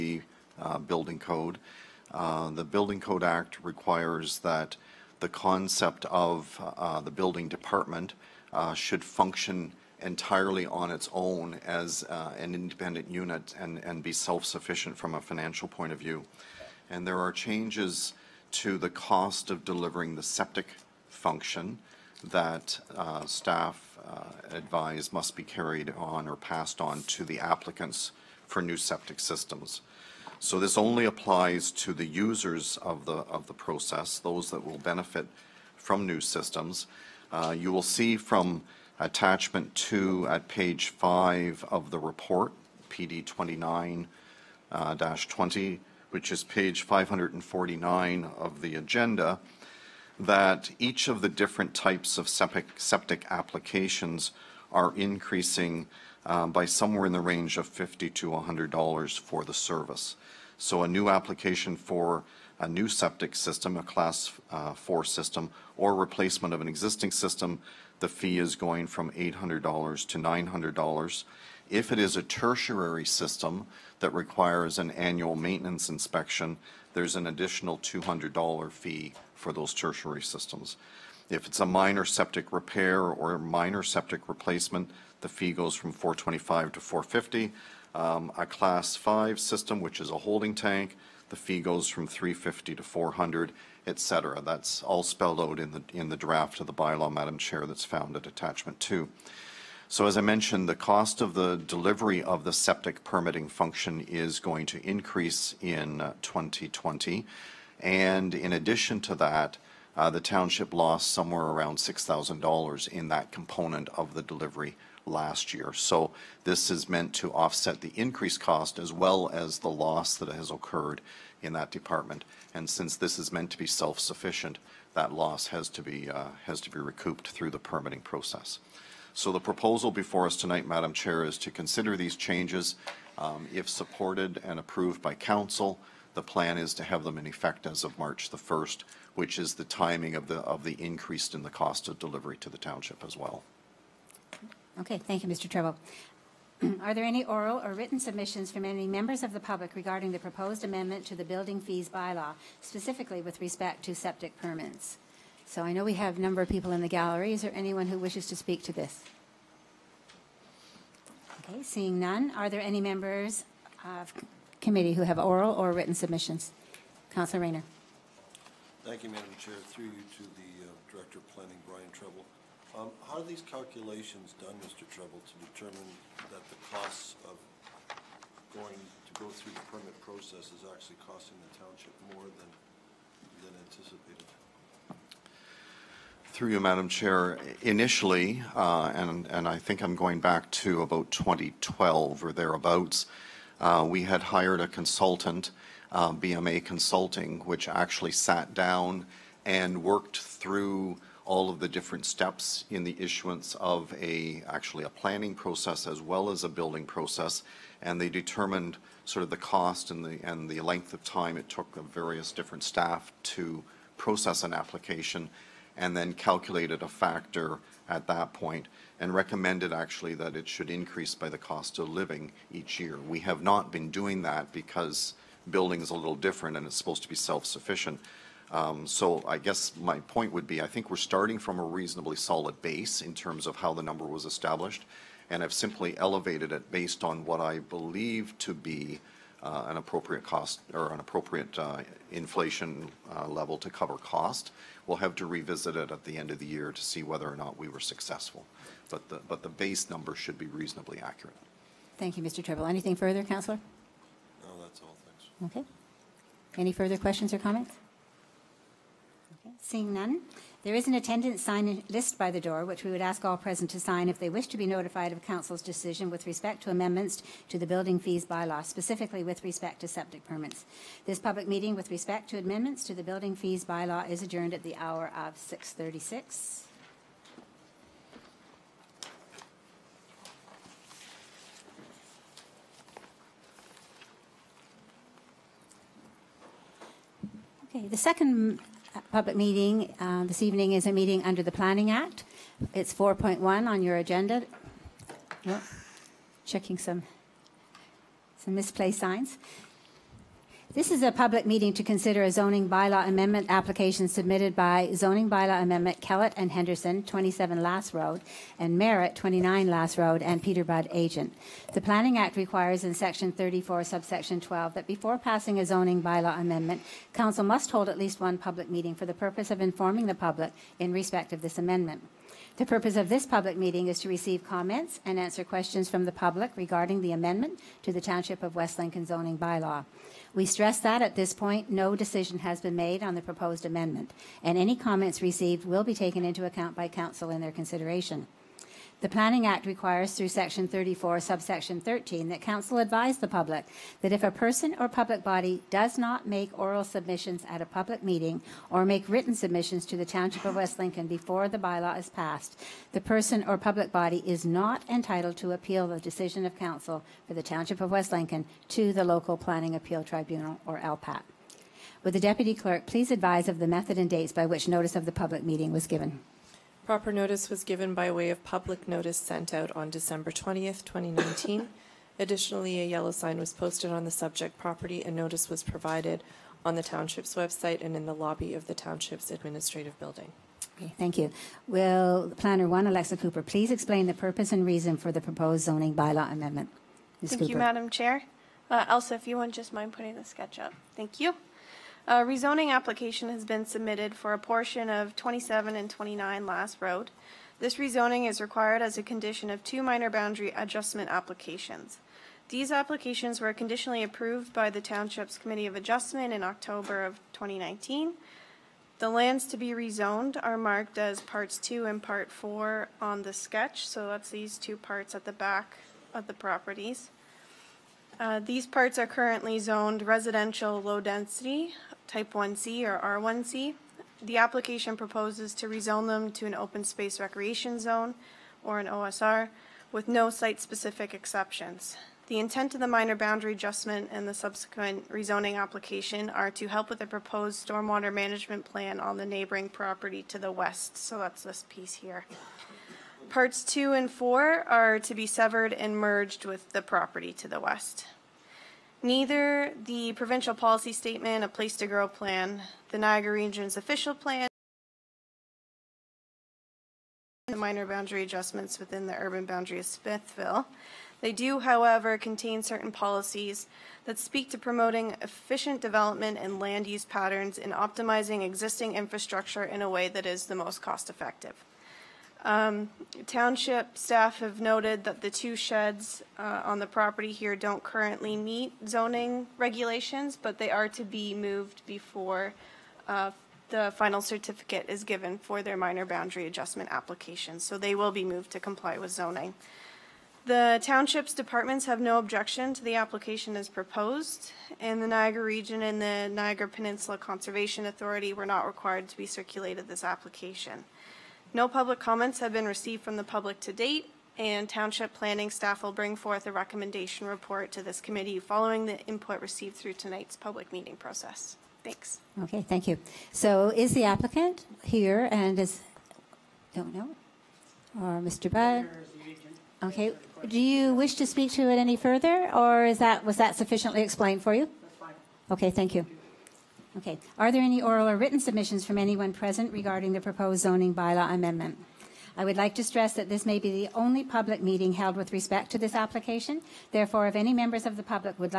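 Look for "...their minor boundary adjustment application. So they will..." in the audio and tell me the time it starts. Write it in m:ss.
8:05.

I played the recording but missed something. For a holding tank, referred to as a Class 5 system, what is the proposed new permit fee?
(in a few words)
$400.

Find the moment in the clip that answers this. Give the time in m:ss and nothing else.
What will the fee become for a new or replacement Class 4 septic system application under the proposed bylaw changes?
1:10.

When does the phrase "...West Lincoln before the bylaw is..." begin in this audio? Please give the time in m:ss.
5:50.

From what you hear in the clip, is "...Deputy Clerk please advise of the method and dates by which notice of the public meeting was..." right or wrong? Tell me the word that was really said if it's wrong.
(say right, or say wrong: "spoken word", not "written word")
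right.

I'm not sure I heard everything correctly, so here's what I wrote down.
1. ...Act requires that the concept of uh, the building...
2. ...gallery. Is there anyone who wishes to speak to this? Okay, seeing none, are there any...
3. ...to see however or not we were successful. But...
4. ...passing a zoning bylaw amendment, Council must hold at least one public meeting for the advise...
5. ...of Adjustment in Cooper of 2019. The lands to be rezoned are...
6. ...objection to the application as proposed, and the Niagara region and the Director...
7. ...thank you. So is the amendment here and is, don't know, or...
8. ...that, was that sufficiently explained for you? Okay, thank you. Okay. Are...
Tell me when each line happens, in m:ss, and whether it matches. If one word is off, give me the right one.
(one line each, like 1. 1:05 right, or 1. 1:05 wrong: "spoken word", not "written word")
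1. 0:03 right
2. 2:36 right
3. 4:06 wrong: "whether", not "however"
4. 5:15 wrong: "purpose", not "advise"
5. 6:45 wrong: "October", not "Cooper"
6. 8:12 wrong: "Niagara", not "Director"
7. 8:32 wrong: "applicant", not "amendment"
8. 8:42 right.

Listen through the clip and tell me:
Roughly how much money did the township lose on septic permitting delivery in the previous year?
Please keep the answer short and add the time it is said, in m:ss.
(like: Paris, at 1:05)
$6,000, at 1:51.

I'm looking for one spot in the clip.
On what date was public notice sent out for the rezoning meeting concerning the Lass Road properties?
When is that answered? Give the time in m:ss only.
6:09.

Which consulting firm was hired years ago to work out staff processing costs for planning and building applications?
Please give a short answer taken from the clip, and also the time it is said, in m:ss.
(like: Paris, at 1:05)
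BMA Consulting, at 3:16.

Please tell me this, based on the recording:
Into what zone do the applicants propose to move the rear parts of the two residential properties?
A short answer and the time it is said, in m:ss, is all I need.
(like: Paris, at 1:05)
Open space recreation, at 7:06.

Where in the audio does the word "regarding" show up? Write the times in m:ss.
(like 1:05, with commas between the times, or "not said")
2:29, 5:26, 8:49.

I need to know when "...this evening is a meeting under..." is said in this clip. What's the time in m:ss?
4:50.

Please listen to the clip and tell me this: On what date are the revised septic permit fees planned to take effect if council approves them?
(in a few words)
March 1.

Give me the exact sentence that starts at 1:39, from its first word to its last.
So as I mentioned, the cost of the delivery of the septic permitting function is going to increase in 2020.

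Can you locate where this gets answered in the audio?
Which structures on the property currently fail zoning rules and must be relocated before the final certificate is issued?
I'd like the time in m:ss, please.
7:55.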